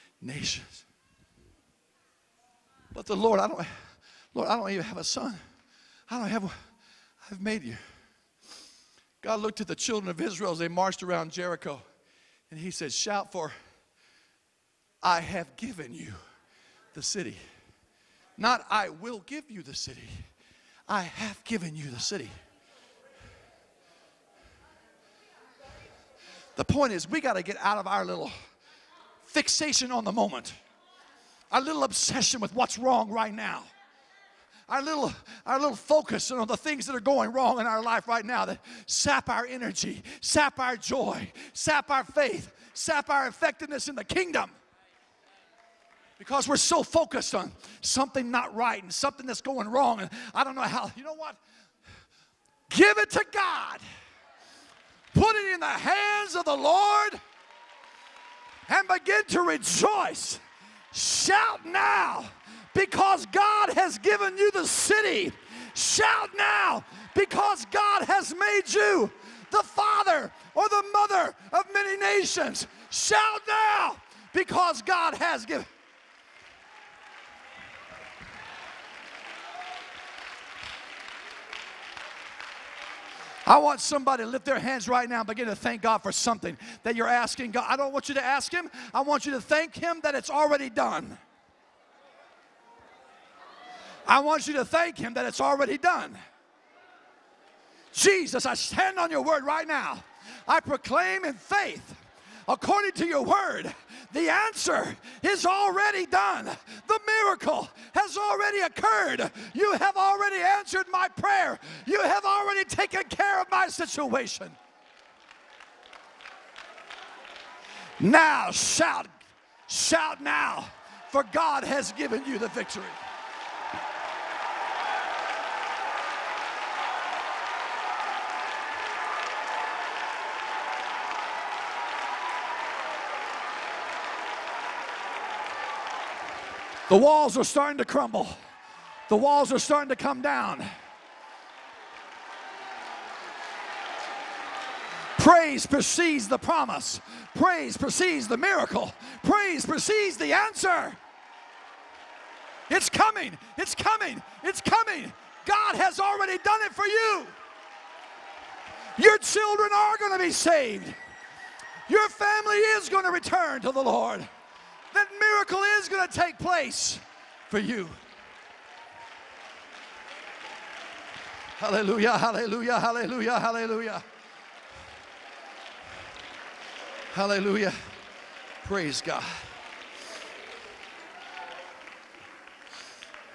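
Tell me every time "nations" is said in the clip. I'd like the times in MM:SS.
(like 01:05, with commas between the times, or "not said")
00:00, 01:11.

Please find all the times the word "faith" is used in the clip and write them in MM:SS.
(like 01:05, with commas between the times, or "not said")
00:42, 01:41.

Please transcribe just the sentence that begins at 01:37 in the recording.
Jesus, I stand on your word right now.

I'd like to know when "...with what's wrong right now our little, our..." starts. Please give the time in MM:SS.
00:32.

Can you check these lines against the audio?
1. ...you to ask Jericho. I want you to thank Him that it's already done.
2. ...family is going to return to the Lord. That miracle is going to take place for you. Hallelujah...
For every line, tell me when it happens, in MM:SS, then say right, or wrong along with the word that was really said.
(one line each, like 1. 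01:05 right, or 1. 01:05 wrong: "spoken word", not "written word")
1. 01:28 wrong: "Him", not "Jericho"
2. 02:42 right.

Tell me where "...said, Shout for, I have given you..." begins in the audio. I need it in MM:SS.
00:12.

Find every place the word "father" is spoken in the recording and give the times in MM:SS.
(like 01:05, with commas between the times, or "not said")
01:09.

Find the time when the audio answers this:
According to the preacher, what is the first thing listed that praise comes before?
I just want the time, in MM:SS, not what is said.
02:26.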